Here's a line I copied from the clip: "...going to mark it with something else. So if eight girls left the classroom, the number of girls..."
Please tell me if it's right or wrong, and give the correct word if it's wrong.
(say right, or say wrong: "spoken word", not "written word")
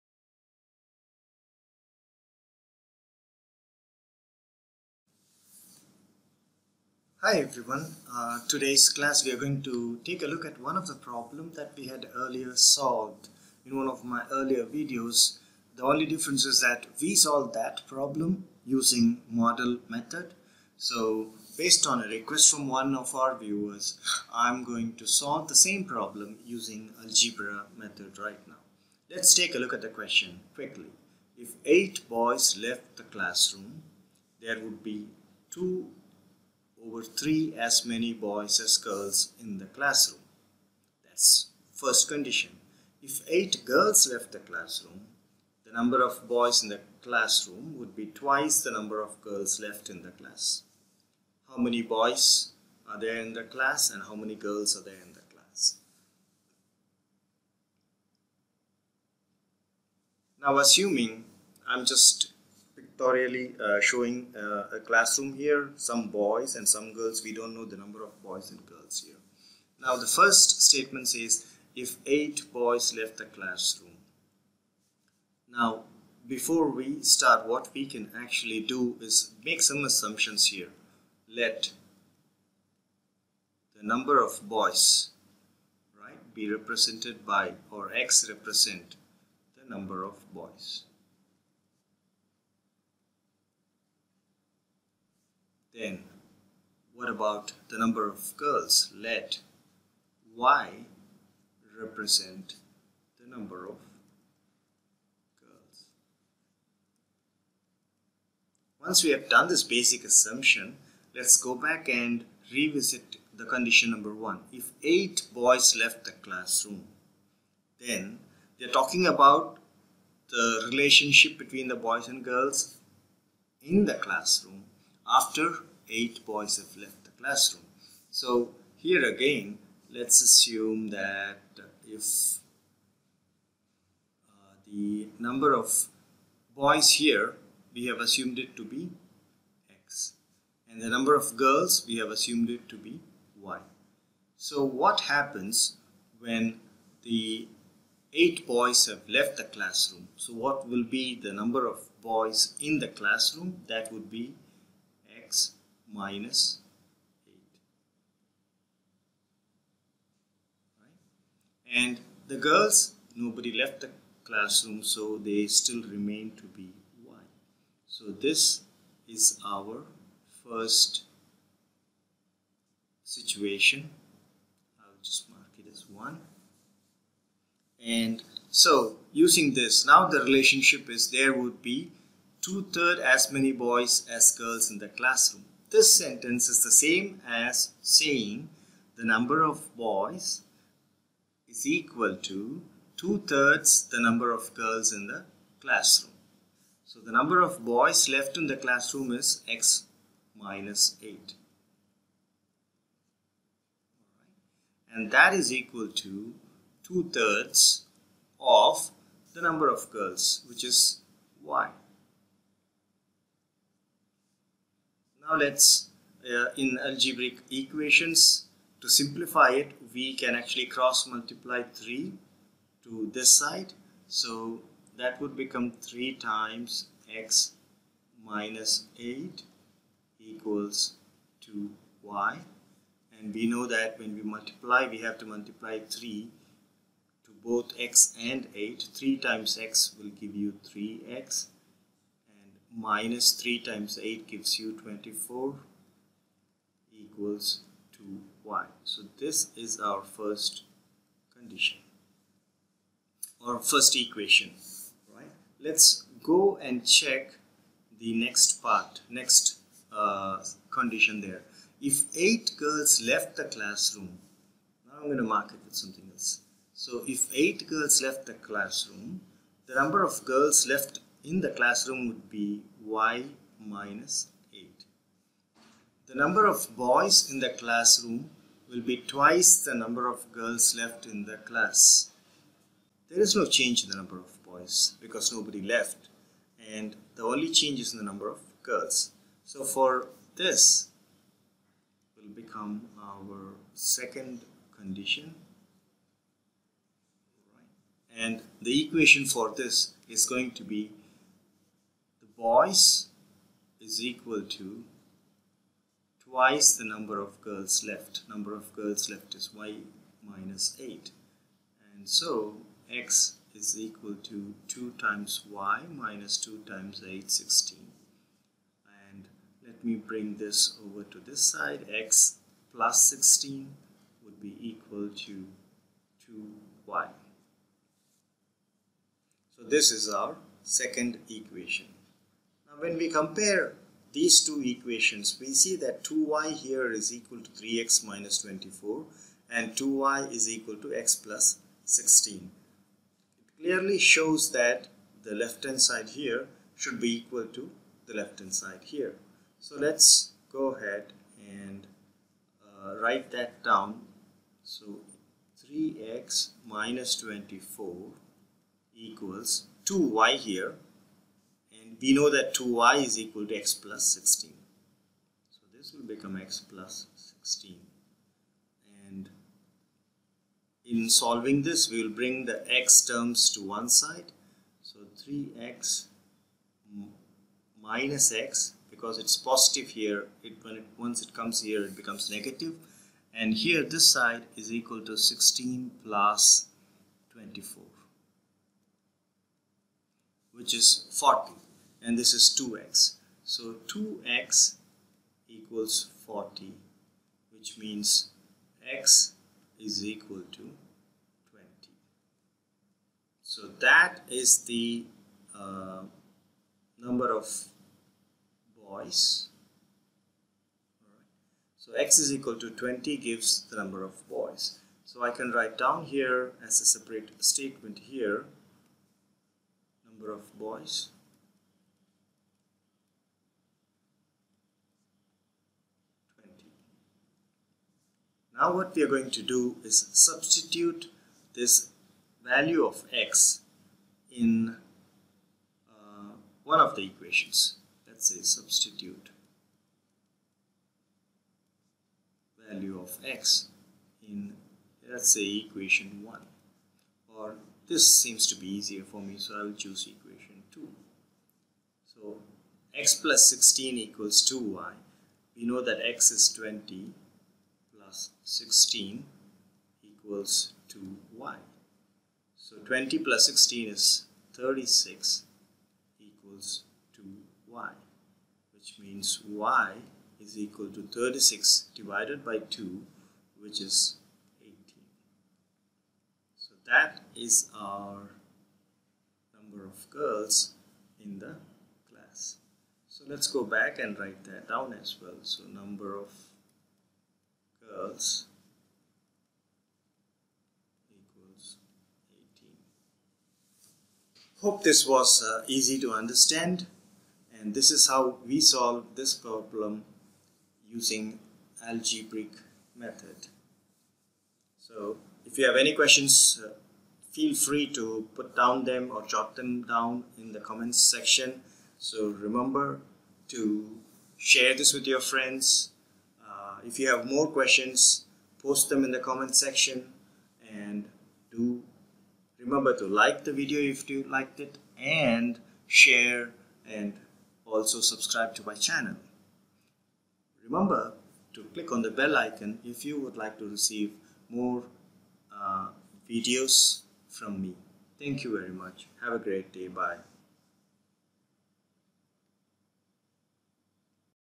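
right.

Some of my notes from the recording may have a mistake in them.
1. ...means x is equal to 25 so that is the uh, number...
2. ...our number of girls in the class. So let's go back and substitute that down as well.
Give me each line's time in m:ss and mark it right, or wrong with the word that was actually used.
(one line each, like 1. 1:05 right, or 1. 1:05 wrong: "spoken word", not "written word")
1. 6:37 wrong: "20", not "25"
2. 7:57 wrong: "write", not "substitute".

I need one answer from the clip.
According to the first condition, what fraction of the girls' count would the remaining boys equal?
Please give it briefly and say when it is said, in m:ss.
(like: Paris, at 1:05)
2/3, at 0:35.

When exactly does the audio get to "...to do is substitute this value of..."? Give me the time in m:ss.
7:09.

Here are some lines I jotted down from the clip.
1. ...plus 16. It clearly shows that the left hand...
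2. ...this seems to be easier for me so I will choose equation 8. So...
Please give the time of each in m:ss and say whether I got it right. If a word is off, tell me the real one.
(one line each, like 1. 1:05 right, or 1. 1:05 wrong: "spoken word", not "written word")
1. 5:41 right
2. 7:27 wrong: "2", not "8".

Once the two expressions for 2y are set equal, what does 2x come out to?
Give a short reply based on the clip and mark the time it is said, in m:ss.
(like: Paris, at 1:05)
40, at 6:33.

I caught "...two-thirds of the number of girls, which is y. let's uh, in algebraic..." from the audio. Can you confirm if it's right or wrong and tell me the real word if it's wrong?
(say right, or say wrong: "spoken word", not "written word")
right.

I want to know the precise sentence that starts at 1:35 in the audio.
Then, what about the number of girls?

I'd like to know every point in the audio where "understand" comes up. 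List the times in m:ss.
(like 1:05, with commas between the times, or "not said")
8:16.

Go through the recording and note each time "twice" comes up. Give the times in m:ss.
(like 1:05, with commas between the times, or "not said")
0:48, 4:38, 5:06.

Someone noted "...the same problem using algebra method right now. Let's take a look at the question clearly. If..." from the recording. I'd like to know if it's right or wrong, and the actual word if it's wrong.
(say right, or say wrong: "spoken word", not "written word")
wrong: "quickly", not "clearly".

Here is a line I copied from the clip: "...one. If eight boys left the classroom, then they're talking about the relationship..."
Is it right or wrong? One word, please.
right.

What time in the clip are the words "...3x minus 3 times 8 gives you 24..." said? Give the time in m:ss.
4:00.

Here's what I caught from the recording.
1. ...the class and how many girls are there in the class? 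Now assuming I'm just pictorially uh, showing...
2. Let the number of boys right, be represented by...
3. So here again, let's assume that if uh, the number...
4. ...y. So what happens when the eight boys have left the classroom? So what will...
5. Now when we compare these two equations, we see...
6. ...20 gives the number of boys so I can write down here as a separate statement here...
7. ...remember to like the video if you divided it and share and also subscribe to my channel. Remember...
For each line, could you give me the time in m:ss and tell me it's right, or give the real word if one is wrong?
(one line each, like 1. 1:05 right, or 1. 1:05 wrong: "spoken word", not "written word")
1. 0:53 right
2. 1:21 right
3. 2:08 right
4. 2:23 right
5. 5:32 right
6. 6:52 right
7. 8:42 wrong: "liked", not "divided".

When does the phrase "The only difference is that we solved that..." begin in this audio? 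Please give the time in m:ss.
0:15.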